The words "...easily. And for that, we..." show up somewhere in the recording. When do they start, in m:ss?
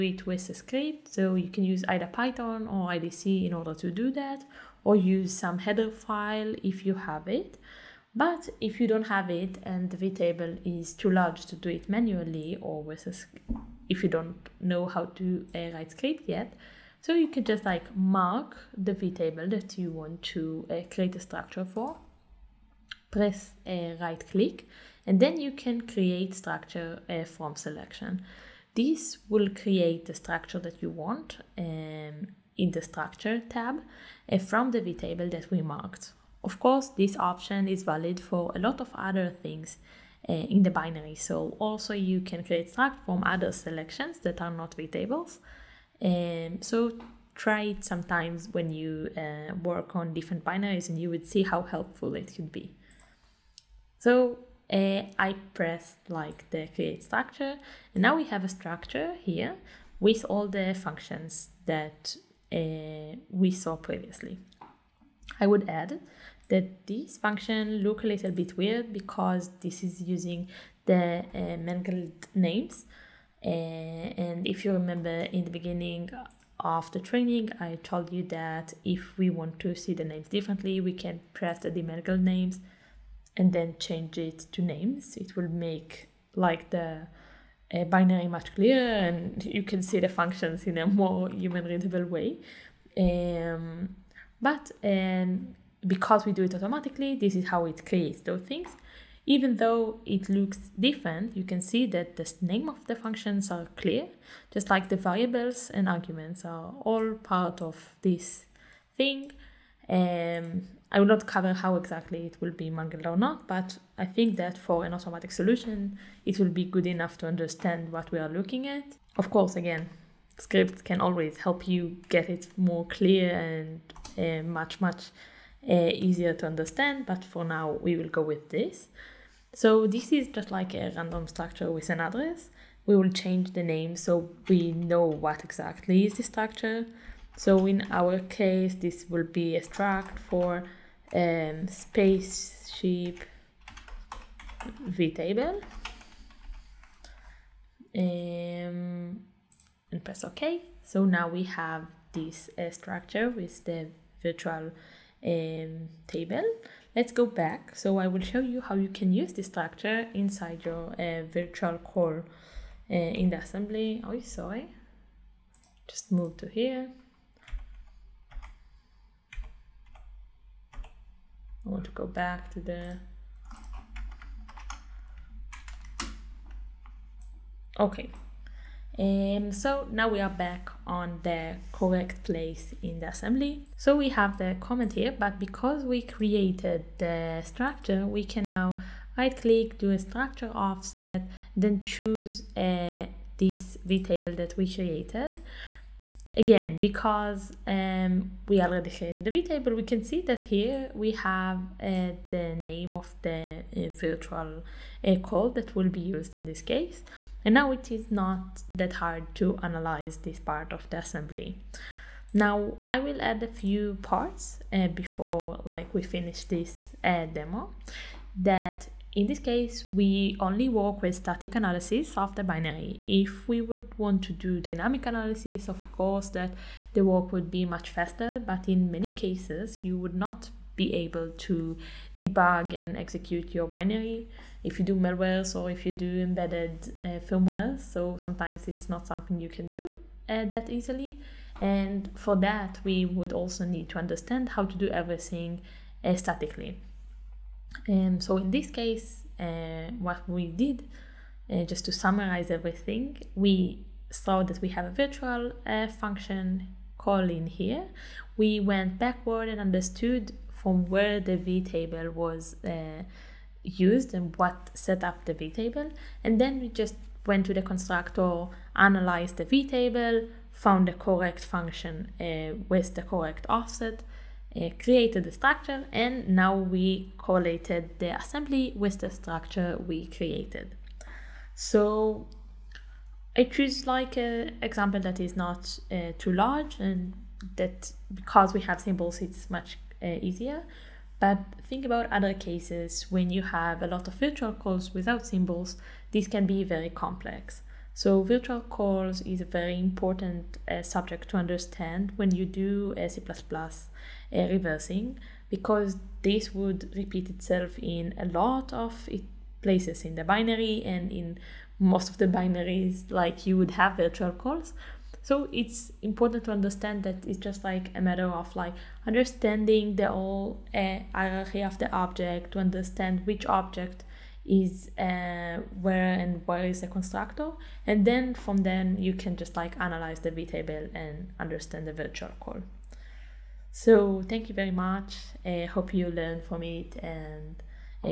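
4:00.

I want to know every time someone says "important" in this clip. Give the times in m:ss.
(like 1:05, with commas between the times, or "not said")
4:59, 5:16.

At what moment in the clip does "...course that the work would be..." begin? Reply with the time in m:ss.
3:45.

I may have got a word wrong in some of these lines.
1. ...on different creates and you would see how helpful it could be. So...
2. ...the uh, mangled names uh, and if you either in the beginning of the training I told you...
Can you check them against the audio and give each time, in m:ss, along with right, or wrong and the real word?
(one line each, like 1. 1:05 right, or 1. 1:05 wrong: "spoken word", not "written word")
1. 0:49 wrong: "binaries", not "creates"
2. 1:10 wrong: "remember", not "either".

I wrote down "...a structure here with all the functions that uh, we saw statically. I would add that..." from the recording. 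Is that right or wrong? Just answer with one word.
wrong.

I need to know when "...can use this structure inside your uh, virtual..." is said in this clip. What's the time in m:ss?
2:38.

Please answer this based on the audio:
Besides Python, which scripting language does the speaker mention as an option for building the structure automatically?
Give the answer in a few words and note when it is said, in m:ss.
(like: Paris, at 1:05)
IDC, at 0:02.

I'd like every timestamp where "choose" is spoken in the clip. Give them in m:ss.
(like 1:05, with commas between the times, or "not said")
3:11, 4:43.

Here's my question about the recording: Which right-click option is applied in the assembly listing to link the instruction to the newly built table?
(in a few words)
Structure offset.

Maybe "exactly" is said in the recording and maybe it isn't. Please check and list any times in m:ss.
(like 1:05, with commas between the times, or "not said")
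1:51, 2:15.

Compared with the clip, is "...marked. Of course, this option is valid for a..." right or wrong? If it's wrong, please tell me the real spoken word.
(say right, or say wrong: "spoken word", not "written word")
right.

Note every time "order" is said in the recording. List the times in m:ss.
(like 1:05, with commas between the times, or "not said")
0:03.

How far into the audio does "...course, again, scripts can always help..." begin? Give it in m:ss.
1:59.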